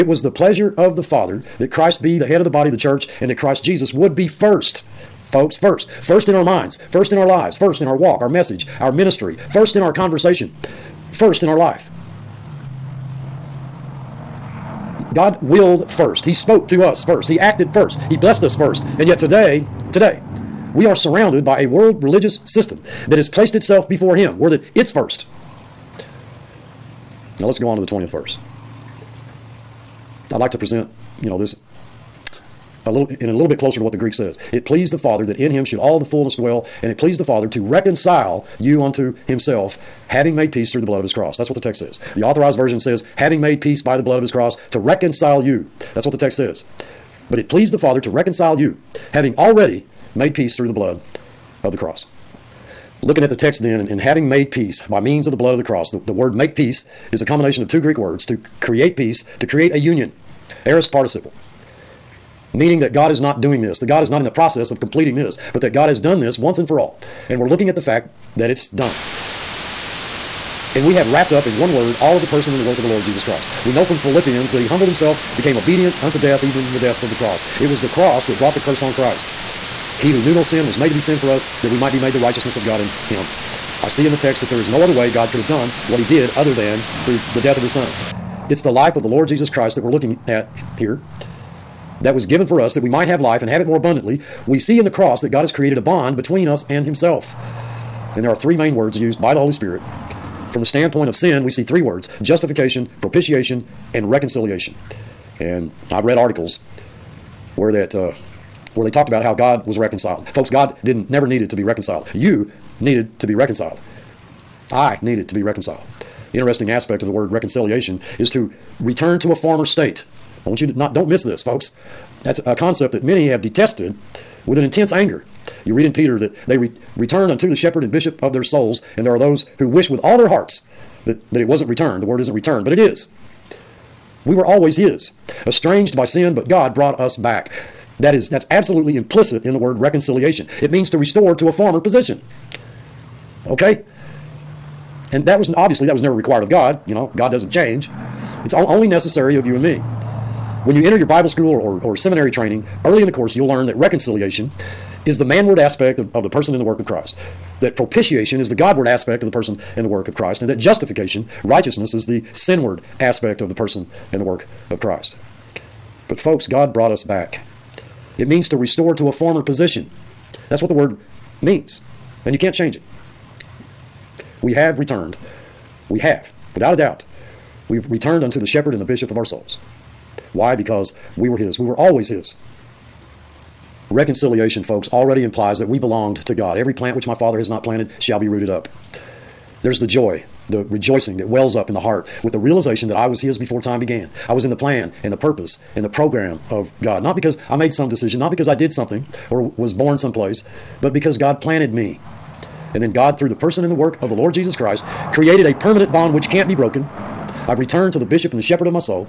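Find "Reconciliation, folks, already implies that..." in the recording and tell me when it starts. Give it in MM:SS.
03:03.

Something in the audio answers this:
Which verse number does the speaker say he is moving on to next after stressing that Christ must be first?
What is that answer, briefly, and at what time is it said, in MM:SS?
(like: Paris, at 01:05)
20th, at 00:27.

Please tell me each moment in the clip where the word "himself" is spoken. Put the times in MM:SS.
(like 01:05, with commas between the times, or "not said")
00:39, 01:14, 01:36.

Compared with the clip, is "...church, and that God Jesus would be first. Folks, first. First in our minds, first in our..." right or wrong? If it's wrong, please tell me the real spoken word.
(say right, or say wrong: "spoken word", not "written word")
wrong: "Christ", not "God".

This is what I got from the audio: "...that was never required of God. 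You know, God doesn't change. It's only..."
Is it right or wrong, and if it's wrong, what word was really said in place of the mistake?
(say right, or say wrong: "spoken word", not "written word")
right.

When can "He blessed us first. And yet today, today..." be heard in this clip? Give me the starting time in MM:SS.
00:18.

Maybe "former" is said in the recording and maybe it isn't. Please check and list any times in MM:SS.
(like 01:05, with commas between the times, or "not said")
01:59, 02:21, 02:49.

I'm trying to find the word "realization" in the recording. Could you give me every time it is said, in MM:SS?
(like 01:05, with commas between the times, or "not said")
03:12.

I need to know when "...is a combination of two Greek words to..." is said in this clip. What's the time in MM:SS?
00:57.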